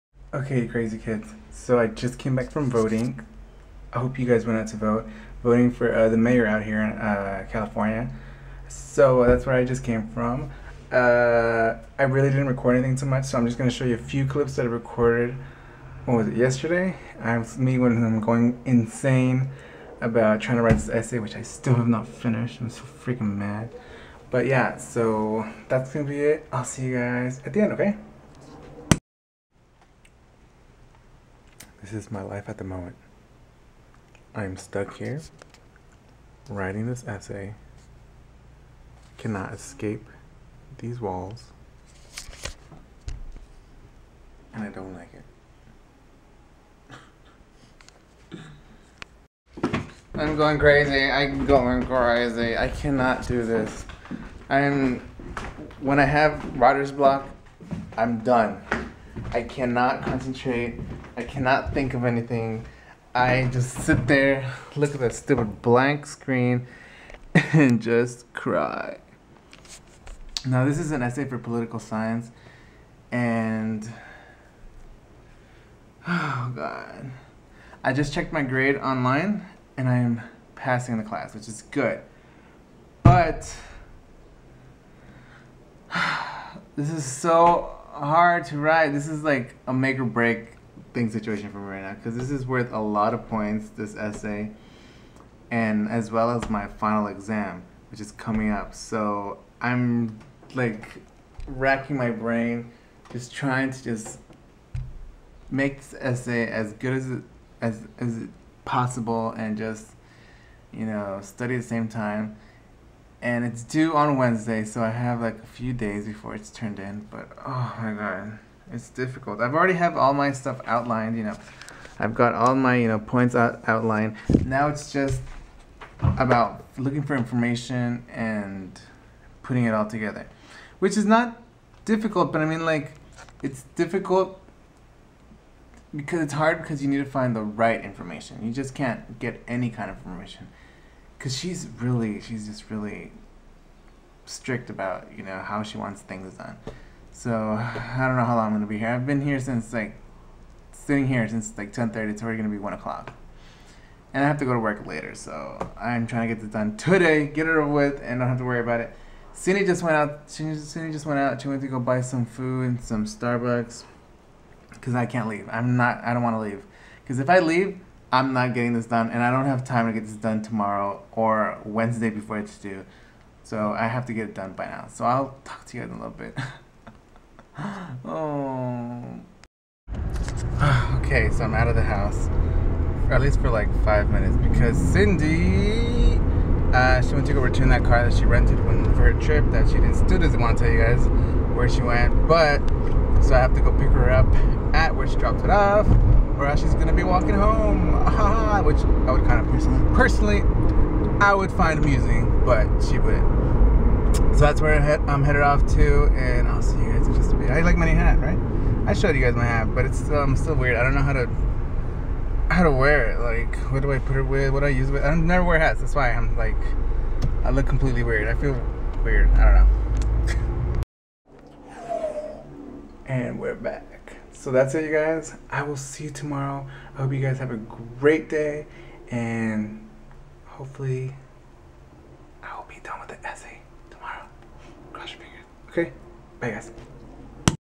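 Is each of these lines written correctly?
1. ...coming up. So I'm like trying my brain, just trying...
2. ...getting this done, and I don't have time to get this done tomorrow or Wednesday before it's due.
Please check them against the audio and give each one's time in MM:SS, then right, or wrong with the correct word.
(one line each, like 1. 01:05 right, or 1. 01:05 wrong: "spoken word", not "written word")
1. 01:38 wrong: "racking", not "trying"
2. 02:48 right.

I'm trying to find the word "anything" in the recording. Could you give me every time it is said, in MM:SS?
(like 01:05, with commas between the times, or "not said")
00:12, 01:02.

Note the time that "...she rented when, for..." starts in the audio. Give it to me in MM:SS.
03:08.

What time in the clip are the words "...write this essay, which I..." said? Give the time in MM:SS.
00:20.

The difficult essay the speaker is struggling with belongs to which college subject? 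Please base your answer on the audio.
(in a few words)
Political science.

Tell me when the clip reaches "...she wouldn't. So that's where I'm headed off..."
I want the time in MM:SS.
03:22.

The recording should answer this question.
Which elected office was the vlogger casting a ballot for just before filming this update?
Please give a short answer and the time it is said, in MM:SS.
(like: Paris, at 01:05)
Mayor, at 00:06.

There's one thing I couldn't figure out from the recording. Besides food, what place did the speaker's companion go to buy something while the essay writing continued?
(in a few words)
Starbucks.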